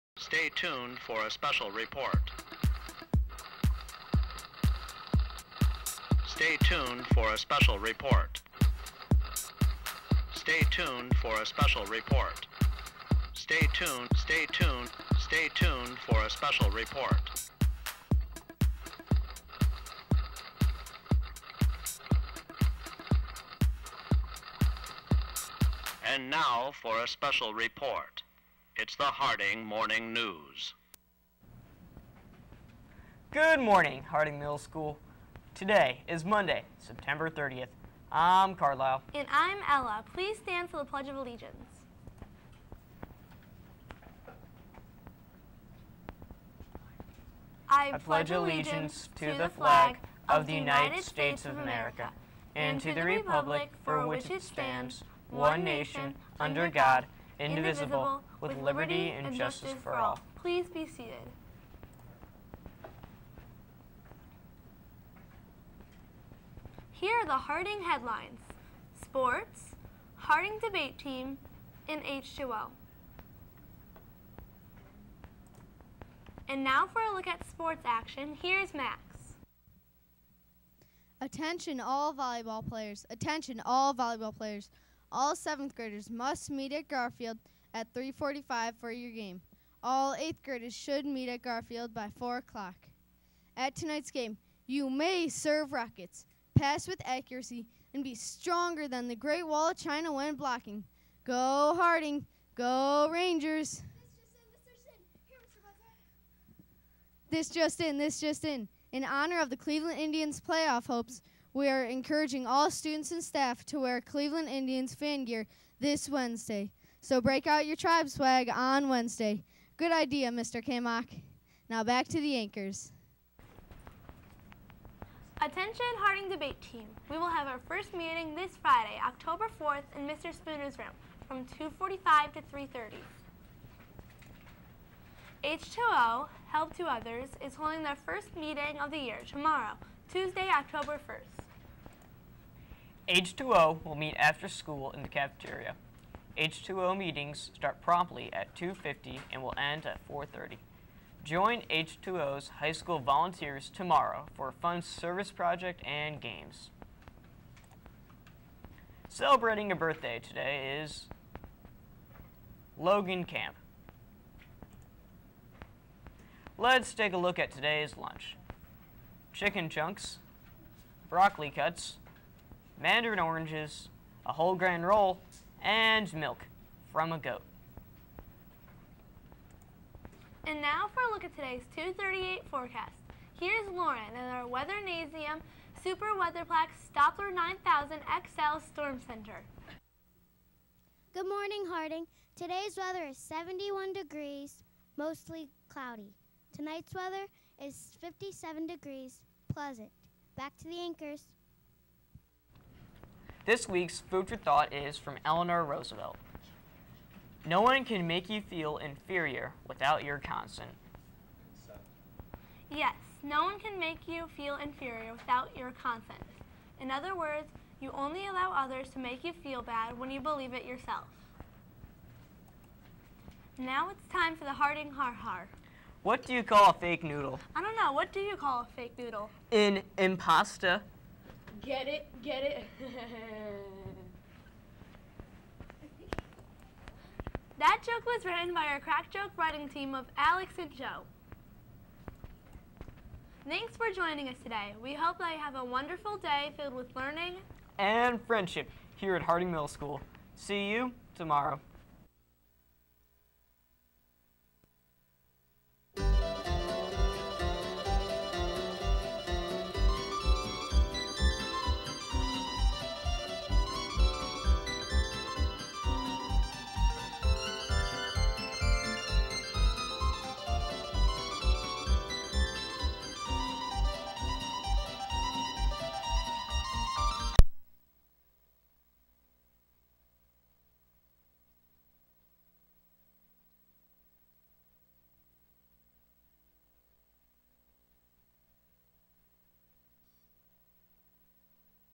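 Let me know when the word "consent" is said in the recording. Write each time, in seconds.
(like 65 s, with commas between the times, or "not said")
210 s, 215 s.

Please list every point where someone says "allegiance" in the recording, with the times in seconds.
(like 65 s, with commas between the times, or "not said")
41 s, 48 s.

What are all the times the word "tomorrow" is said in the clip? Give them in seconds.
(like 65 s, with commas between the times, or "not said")
139 s, 153 s, 251 s.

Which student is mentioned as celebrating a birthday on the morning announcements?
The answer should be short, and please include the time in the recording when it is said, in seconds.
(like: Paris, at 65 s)
Logan Camp, at 162 s.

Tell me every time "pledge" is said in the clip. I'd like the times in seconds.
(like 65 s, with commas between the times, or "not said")
40 s, 48 s.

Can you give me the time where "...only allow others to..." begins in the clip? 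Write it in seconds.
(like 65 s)
217 s.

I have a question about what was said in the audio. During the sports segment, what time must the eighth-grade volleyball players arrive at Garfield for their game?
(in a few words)
4 o'clock.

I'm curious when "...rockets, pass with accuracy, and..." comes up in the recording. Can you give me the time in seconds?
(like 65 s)
95 s.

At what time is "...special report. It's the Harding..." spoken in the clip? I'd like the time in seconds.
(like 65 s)
27 s.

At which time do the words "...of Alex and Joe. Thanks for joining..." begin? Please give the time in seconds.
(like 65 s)
239 s.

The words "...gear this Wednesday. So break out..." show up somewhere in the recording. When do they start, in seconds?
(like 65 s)
115 s.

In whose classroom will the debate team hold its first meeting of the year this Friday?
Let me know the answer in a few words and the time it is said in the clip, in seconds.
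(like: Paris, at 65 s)
Mr. Spooner's room, at 130 s.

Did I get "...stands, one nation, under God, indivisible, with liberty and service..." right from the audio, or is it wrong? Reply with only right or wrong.
wrong.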